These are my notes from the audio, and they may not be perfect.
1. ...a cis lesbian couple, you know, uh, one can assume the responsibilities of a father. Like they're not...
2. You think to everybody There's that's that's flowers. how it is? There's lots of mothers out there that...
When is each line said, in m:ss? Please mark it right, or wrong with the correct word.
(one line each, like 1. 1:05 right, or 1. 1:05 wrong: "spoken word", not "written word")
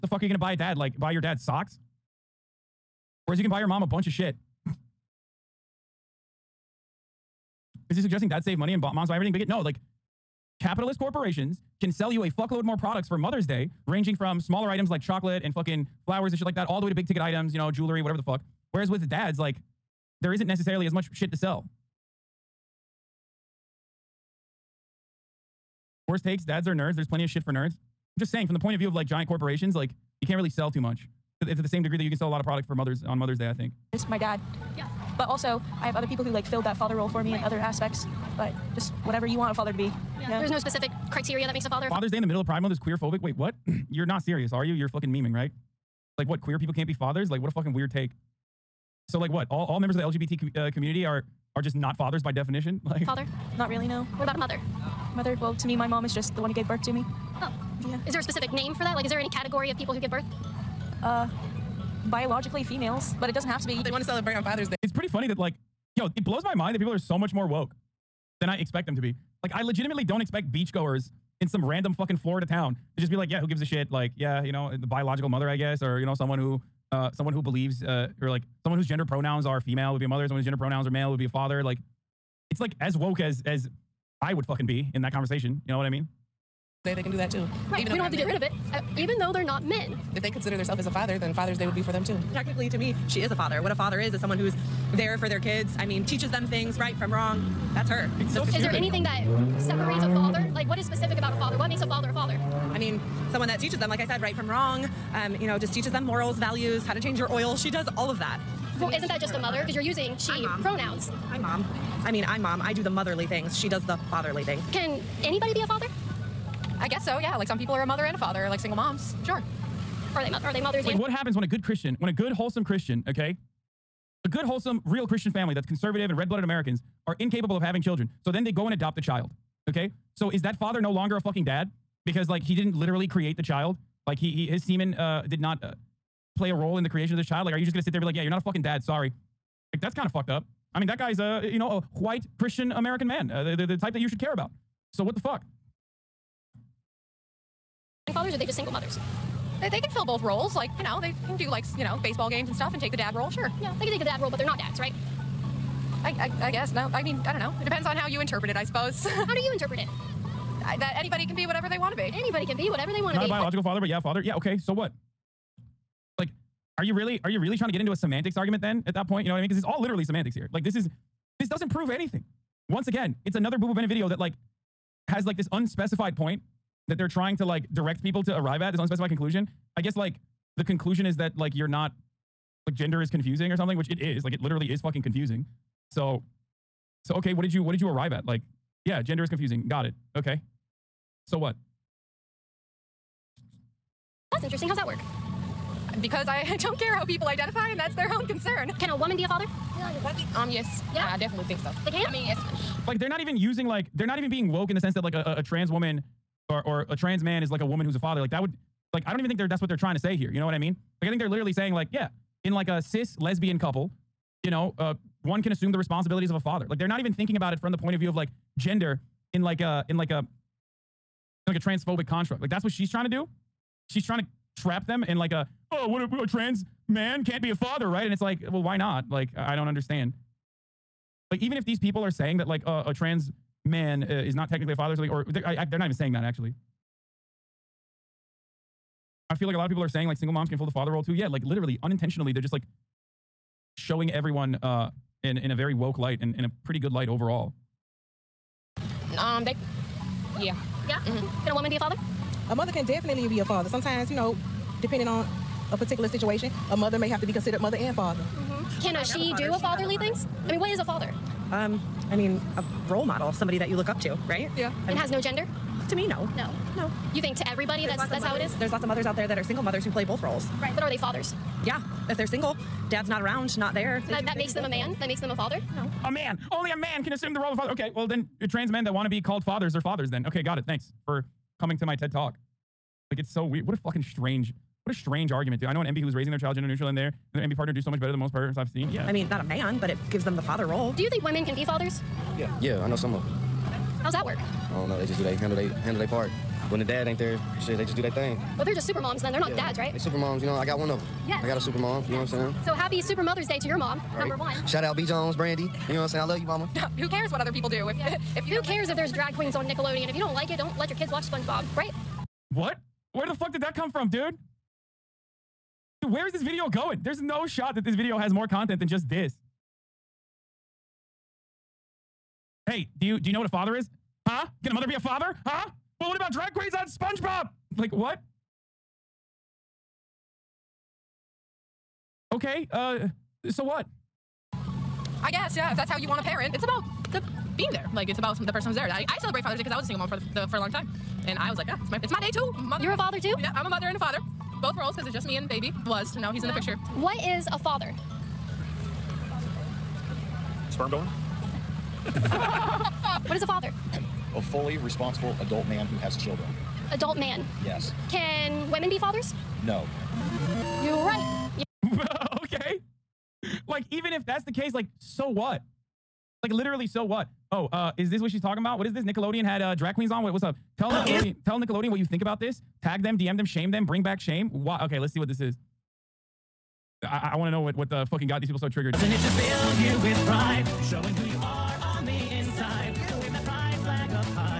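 1. 3:32 right
2. 4:27 wrong: "mothers", not "flowers".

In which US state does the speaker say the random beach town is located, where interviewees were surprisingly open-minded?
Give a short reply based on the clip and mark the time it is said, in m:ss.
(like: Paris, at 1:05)
Florida, at 1:12.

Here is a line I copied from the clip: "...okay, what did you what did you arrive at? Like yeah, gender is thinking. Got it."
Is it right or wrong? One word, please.
wrong.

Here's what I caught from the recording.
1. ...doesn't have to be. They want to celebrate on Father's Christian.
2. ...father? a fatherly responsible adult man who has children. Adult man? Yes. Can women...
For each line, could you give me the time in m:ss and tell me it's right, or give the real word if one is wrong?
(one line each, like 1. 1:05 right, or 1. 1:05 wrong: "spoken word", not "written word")
1. 1:03 wrong: "Day", not "Christian"
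2. 5:53 wrong: "fully", not "fatherly".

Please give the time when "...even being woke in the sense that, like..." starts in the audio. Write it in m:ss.
3:24.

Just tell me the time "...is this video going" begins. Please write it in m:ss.
5:16.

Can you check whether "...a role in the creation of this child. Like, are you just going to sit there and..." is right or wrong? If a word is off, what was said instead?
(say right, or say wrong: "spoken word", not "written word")
right.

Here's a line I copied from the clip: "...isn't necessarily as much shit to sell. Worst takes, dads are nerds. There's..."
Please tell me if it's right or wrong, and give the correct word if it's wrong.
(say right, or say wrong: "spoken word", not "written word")
right.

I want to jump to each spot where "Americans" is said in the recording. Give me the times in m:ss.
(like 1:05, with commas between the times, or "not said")
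2:06, 2:22.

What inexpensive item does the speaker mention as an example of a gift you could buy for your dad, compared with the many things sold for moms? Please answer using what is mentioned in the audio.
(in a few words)
Socks.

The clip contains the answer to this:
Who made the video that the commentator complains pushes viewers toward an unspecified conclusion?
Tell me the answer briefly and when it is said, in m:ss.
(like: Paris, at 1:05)
Boo Boo Bennett, at 2:53.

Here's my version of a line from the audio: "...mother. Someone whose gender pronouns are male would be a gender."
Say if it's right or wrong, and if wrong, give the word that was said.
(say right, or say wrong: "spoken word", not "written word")
wrong: "father", not "gender".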